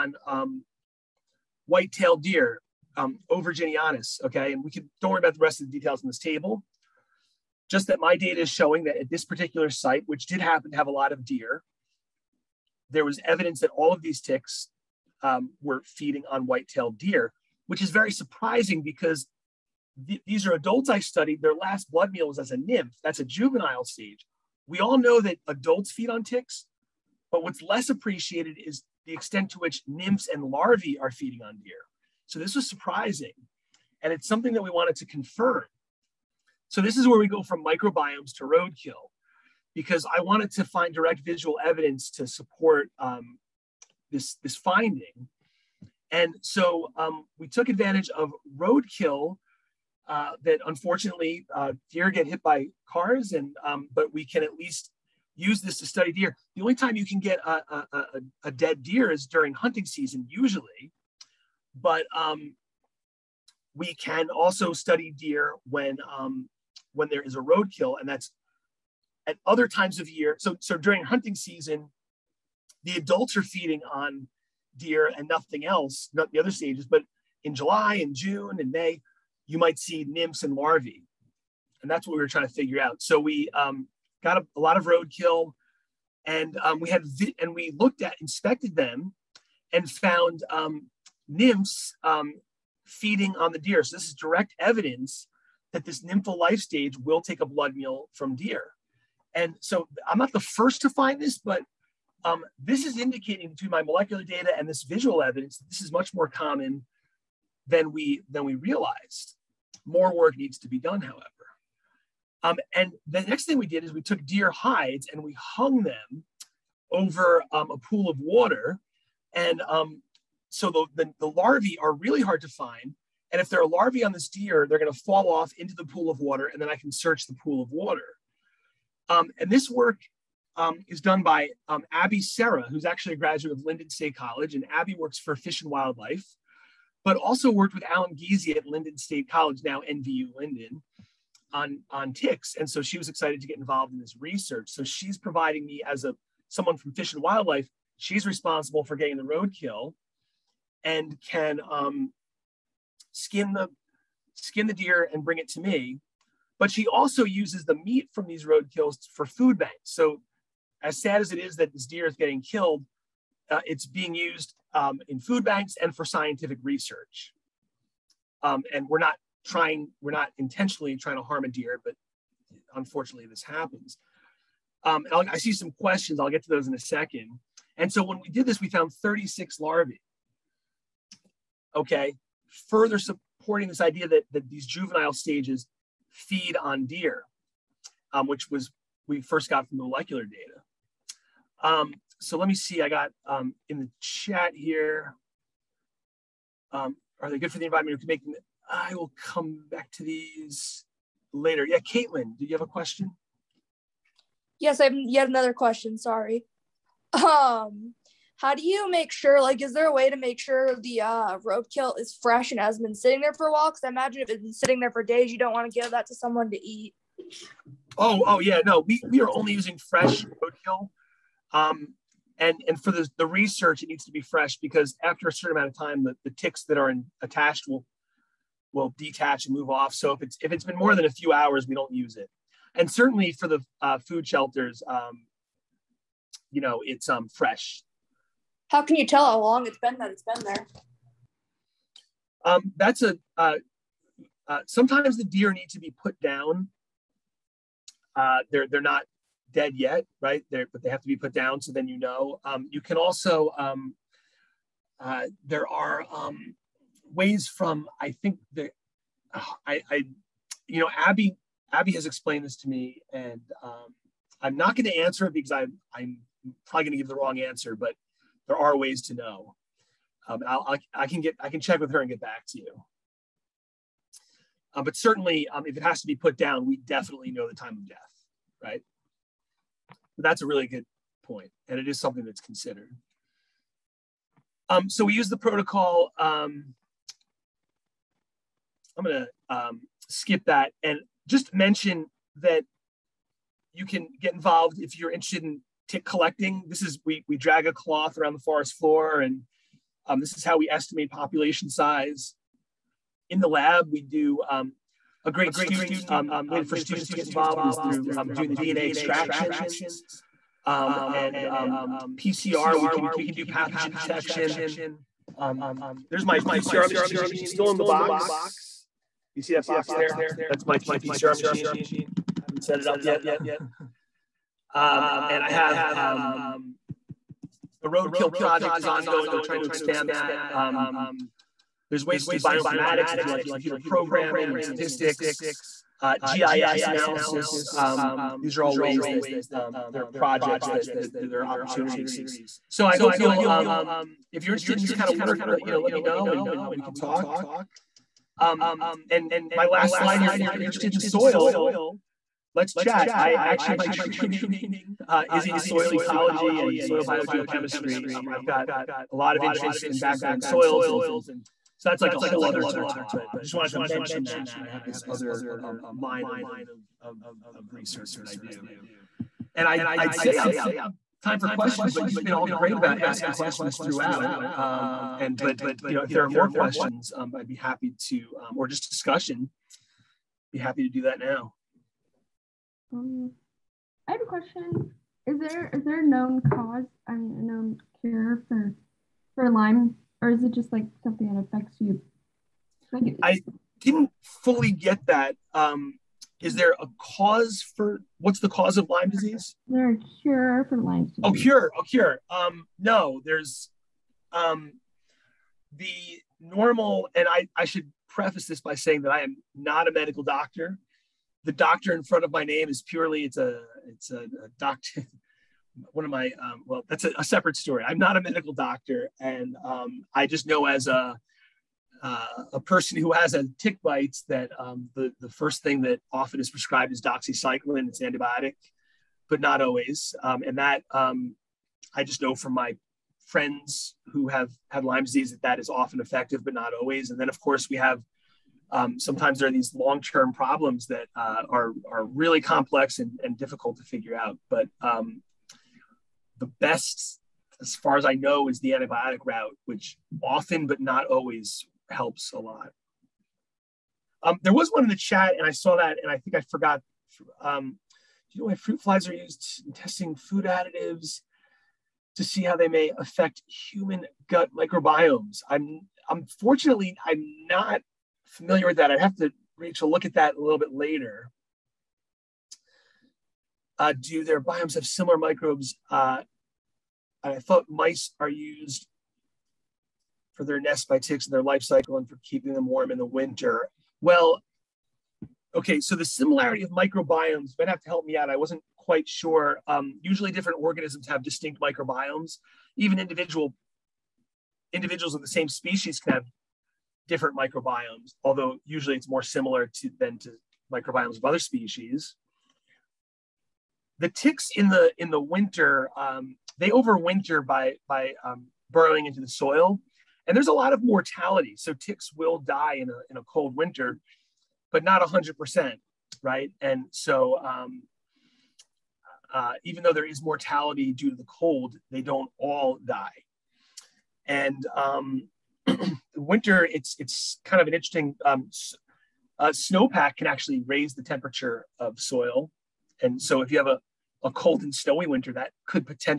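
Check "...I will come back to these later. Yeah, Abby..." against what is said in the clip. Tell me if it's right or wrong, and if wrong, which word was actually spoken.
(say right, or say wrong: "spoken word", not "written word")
wrong: "Caitlin", not "Abby".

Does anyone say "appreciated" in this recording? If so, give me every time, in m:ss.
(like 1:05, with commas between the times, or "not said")
0:27.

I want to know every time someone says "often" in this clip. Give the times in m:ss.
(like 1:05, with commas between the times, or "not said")
7:06, 7:15, 7:30.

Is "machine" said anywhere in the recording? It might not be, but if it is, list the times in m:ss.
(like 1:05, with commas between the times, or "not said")
5:16, 5:21.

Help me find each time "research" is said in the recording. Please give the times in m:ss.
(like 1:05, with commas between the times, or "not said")
2:24, 2:46, 3:43, 6:07.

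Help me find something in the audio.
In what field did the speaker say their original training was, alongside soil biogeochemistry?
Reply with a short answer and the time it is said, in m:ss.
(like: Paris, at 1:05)
Soil ecology, at 5:55.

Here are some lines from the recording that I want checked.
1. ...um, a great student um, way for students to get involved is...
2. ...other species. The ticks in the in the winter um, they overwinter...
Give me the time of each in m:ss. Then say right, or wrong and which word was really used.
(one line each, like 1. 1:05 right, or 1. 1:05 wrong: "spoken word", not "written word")
1. 5:04 right
2. 8:21 right.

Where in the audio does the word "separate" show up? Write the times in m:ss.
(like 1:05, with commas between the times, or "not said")
6:57.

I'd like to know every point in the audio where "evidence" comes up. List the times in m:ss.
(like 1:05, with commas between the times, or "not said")
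0:13, 0:41, 1:34, 1:45.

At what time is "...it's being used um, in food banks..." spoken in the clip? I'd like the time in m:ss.
2:43.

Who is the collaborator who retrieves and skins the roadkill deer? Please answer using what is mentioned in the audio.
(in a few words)
Abby Serra.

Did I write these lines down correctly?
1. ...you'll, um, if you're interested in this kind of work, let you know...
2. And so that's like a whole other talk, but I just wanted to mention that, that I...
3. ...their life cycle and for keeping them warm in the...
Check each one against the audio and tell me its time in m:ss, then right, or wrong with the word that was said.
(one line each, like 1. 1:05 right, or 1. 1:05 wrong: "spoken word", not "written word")
1. 5:43 right
2. 6:00 right
3. 8:01 right.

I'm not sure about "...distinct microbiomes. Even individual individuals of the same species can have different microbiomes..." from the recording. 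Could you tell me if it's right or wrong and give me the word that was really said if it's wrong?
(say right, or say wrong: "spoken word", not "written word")
right.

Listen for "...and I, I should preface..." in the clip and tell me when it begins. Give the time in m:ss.
6:47.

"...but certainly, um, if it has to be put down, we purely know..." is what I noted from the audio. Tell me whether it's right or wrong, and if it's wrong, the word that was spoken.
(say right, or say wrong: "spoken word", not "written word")
wrong: "definitely", not "purely".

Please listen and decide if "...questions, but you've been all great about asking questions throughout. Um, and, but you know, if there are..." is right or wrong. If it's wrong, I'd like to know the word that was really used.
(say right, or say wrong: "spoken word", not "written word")
right.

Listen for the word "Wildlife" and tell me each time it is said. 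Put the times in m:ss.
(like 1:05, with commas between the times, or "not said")
2:15, 2:27.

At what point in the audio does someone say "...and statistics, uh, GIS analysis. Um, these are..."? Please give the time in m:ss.
5:34.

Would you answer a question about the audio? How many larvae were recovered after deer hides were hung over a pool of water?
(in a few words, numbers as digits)
36.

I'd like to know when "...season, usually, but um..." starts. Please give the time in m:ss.
0:59.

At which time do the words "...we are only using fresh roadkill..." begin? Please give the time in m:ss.
3:39.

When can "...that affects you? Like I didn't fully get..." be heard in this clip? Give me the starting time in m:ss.
6:31.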